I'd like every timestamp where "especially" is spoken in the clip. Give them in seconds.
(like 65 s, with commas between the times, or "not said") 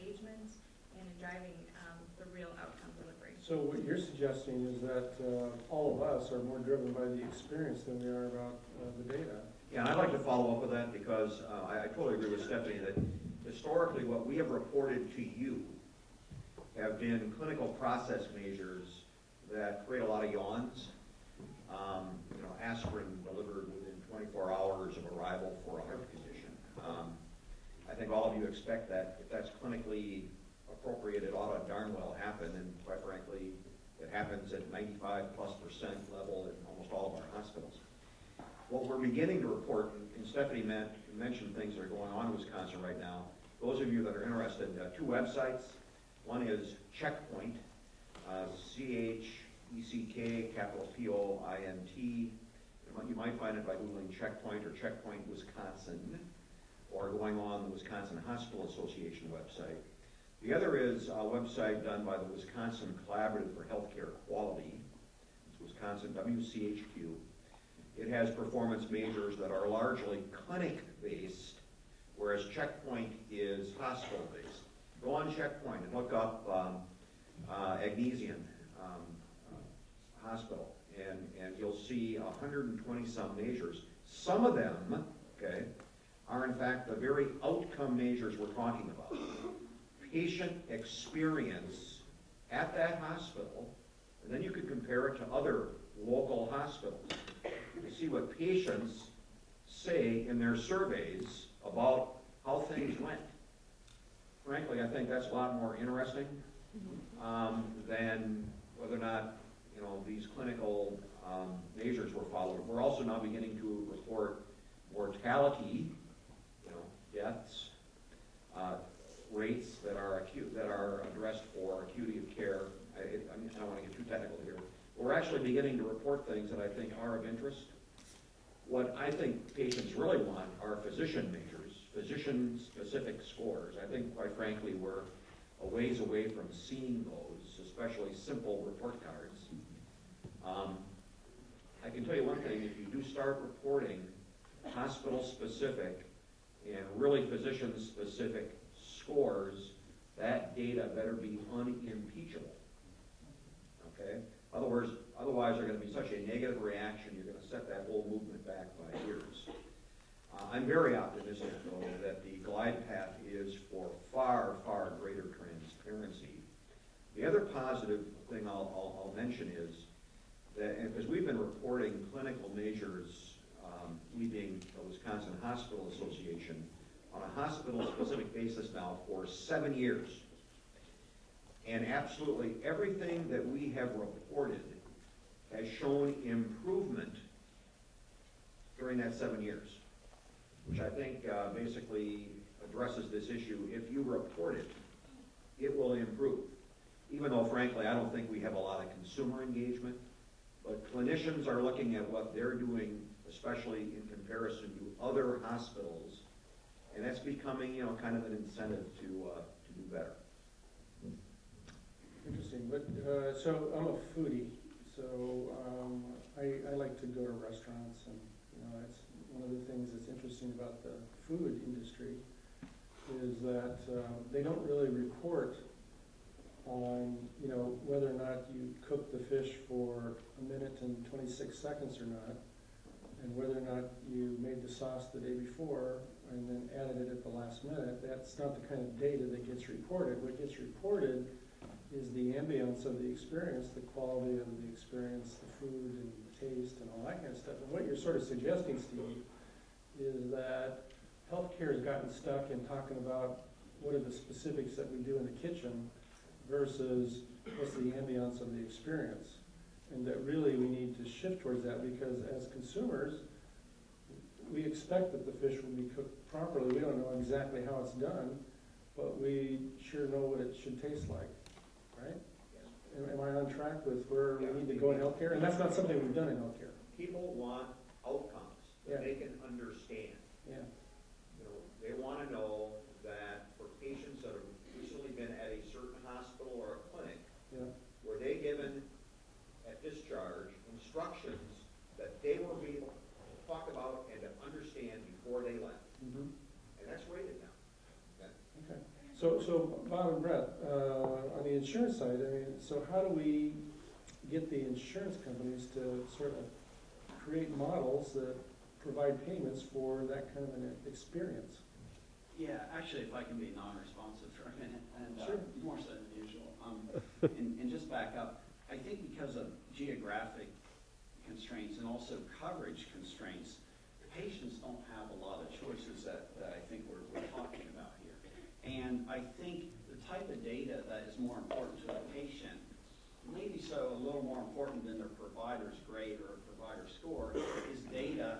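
137 s, 203 s.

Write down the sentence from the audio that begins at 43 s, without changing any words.
Those of you that are interested, uh, two websites.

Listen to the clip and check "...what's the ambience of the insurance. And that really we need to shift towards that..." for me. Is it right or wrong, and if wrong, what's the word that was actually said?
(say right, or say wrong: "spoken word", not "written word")
wrong: "experience", not "insurance".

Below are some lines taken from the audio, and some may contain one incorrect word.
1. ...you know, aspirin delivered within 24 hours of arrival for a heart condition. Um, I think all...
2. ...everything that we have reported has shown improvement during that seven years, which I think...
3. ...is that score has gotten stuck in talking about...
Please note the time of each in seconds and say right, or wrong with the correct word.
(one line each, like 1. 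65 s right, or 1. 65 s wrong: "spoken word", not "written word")
1. 22 s right
2. 182 s right
3. 250 s wrong: "healthcare", not "score".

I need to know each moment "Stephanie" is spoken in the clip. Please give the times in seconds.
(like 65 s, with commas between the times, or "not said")
12 s, 40 s.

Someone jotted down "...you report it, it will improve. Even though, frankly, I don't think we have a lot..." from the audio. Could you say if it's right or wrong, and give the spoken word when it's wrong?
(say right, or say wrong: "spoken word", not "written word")
right.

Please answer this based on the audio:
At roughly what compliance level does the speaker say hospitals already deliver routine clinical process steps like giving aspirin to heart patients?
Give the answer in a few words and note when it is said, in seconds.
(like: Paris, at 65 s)
95 plus percent, at 34 s.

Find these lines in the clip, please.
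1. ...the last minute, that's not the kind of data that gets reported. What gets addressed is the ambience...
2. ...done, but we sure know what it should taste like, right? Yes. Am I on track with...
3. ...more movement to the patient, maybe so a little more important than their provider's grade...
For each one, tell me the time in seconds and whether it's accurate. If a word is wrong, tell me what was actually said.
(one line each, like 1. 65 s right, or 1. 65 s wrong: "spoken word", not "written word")
1. 237 s wrong: "reported", not "addressed"
2. 267 s right
3. 331 s wrong: "important", not "movement".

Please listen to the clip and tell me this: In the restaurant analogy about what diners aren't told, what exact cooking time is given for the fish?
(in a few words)
1 minute and 26 seconds.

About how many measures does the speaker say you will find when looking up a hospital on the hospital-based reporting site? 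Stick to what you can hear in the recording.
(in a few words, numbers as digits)
120 some.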